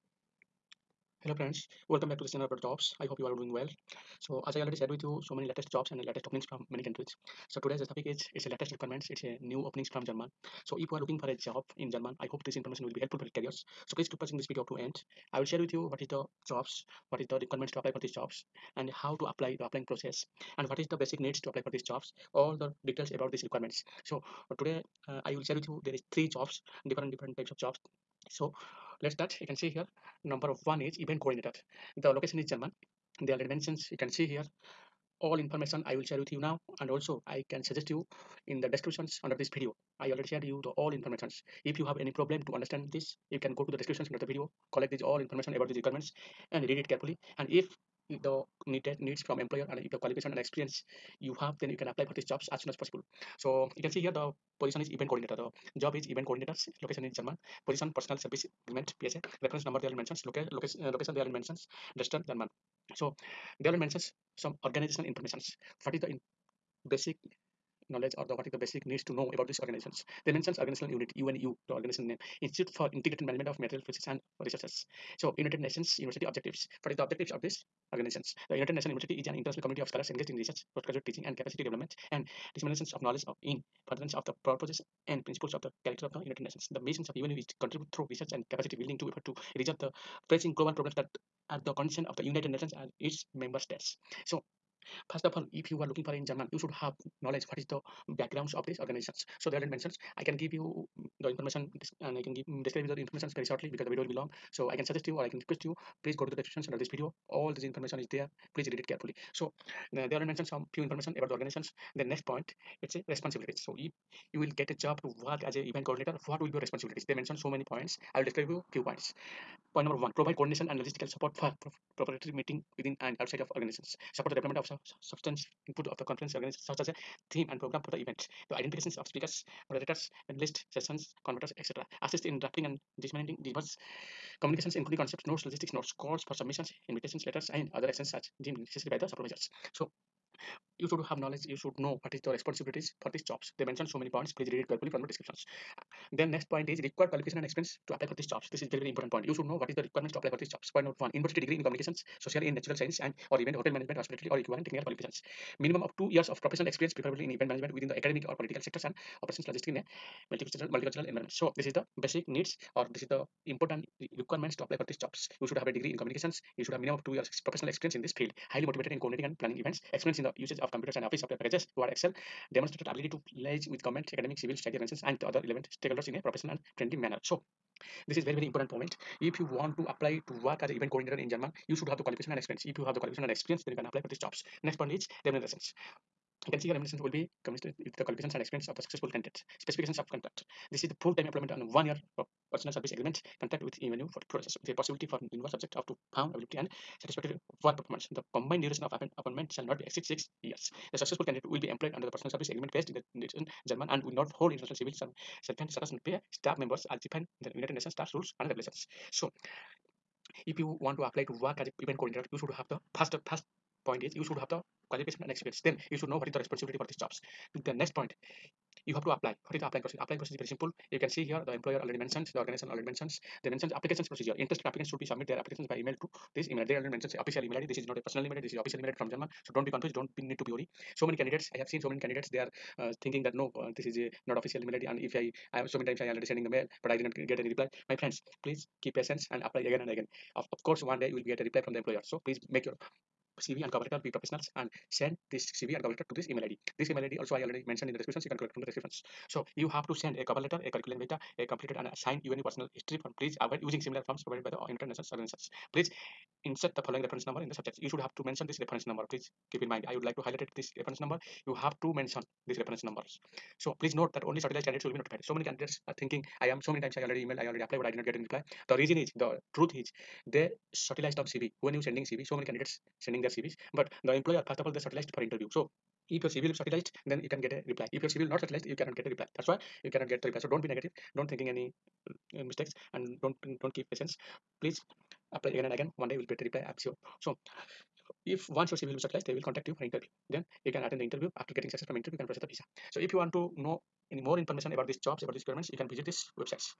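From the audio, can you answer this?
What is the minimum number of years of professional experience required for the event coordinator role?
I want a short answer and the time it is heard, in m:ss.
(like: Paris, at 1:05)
2, at 2:35.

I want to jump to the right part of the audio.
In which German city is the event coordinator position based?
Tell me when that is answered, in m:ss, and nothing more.
1:01.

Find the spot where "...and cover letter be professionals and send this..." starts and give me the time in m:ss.
4:03.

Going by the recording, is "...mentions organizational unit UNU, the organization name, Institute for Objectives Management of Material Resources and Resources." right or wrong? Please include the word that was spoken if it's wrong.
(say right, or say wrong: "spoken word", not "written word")
wrong: "Integrated", not "Objectives".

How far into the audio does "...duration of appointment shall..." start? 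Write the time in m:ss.
3:18.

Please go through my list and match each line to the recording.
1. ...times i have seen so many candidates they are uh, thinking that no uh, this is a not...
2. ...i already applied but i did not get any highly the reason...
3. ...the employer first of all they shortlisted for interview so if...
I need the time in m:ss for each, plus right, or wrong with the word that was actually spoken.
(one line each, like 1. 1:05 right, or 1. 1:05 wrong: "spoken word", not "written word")
1. 3:51 wrong: "candidates", not "times"
2. 4:27 wrong: "reply", not "highly"
3. 4:34 right.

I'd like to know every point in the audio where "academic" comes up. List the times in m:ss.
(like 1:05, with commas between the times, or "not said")
2:37, 2:54.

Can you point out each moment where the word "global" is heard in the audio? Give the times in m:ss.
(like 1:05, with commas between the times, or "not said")
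1:30.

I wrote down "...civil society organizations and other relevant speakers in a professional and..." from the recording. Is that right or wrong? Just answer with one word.
wrong.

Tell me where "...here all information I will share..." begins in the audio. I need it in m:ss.
0:34.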